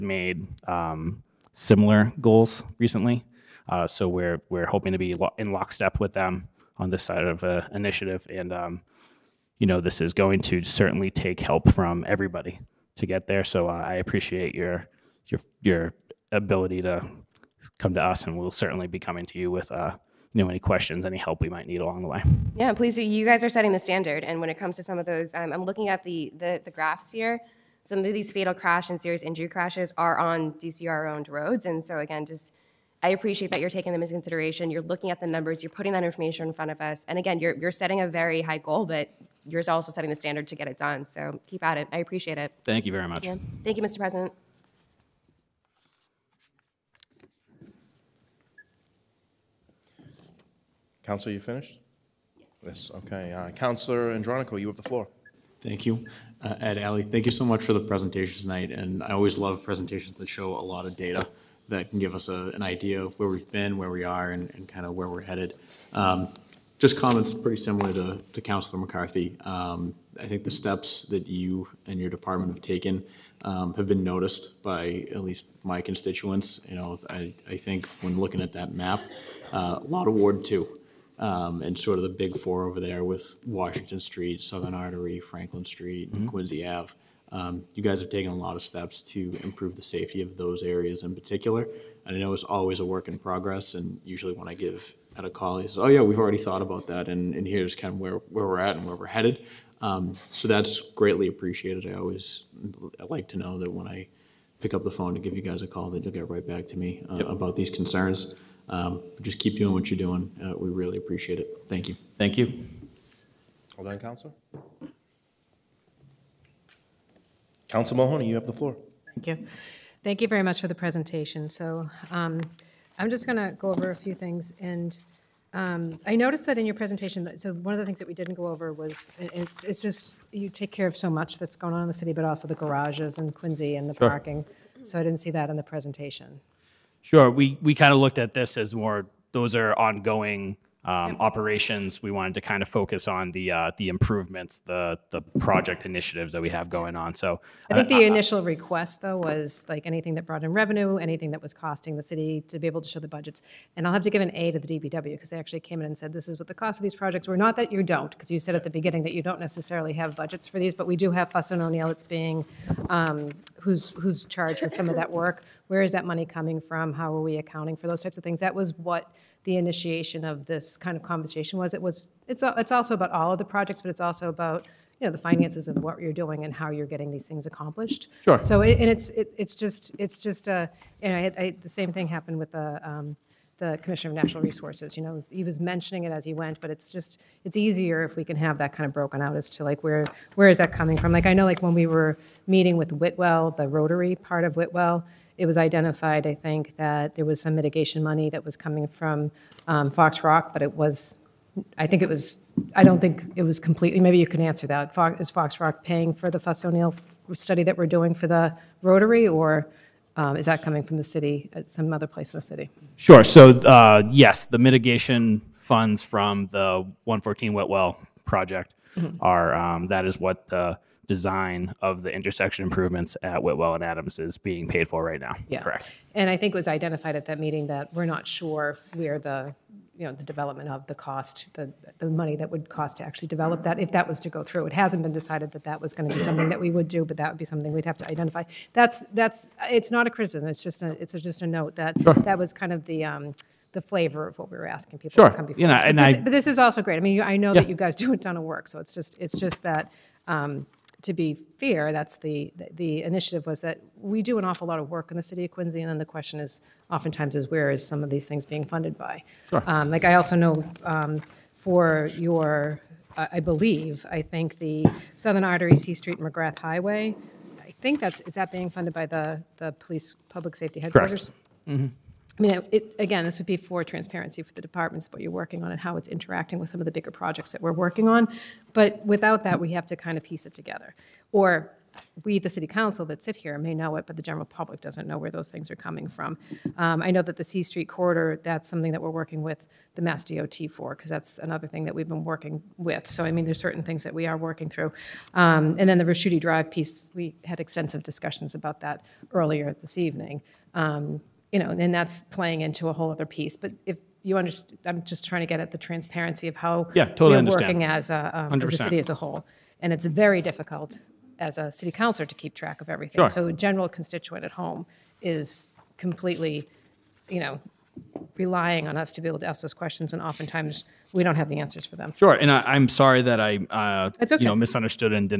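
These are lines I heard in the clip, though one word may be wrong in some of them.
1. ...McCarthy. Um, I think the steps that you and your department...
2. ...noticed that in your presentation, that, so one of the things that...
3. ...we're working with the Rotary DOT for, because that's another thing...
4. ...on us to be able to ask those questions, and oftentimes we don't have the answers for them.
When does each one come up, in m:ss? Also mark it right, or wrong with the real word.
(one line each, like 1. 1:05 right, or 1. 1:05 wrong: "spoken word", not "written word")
1. 1:08 right
2. 2:06 right
3. 4:49 wrong: "Mass", not "Rotary"
4. 5:18 right.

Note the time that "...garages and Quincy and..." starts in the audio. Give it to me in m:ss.
2:12.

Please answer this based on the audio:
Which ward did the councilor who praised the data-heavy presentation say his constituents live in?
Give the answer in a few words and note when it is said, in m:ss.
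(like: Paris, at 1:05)
Ward 2, at 1:20.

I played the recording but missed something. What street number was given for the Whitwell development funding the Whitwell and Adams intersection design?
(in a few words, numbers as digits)
114.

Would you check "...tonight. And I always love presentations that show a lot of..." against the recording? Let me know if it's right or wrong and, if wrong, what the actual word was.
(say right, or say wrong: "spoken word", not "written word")
right.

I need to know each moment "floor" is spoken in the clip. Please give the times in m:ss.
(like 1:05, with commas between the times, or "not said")
0:54, 1:58.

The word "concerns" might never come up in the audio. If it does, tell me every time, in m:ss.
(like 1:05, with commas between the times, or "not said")
1:47.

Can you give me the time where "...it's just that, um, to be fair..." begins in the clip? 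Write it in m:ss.
4:09.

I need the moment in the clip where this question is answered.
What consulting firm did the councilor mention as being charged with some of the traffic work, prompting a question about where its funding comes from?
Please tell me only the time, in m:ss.
2:41.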